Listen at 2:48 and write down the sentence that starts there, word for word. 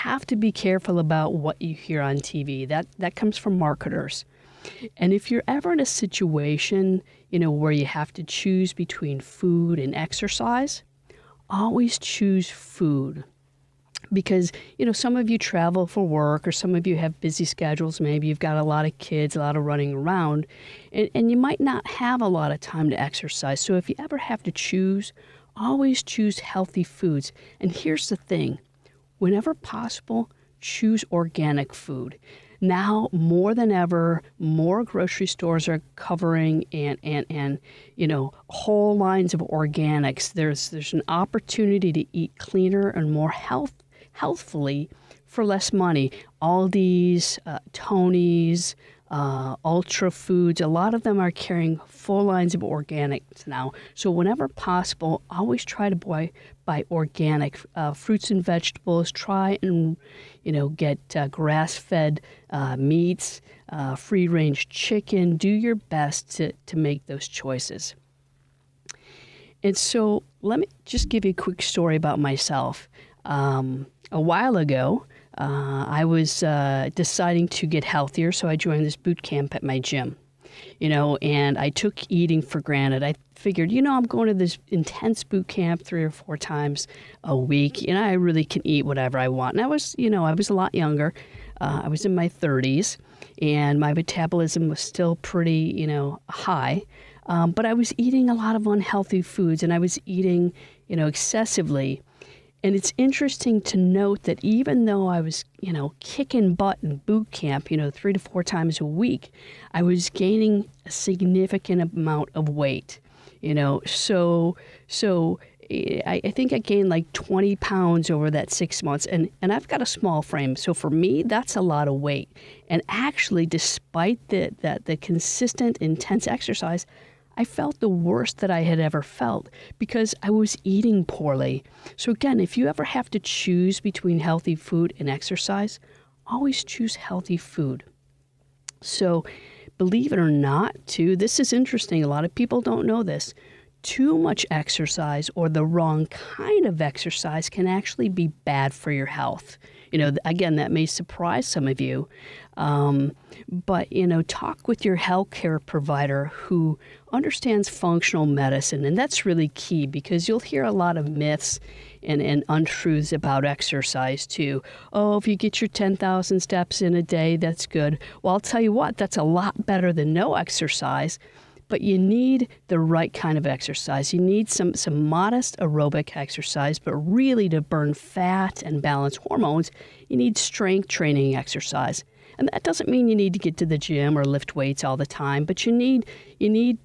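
Well, I'll tell you what, that's a lot better than no exercise but you need the right kind of exercise.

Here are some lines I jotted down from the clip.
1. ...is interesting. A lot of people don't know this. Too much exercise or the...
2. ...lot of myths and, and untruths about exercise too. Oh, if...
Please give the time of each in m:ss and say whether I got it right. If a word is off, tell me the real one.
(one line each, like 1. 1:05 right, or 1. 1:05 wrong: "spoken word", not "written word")
1. 2:21 right
2. 2:40 right.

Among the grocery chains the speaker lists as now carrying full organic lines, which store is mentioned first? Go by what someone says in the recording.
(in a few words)
Aldi's.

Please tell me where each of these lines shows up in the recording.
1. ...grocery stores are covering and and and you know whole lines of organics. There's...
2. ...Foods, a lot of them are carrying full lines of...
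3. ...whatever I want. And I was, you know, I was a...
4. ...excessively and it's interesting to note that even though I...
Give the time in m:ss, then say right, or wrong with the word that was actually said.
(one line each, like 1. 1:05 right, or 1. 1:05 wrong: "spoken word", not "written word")
1. 0:34 right
2. 0:50 right
3. 1:28 right
4. 1:41 right.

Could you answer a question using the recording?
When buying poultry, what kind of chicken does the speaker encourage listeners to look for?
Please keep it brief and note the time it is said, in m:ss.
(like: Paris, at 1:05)
free-range, at 1:03.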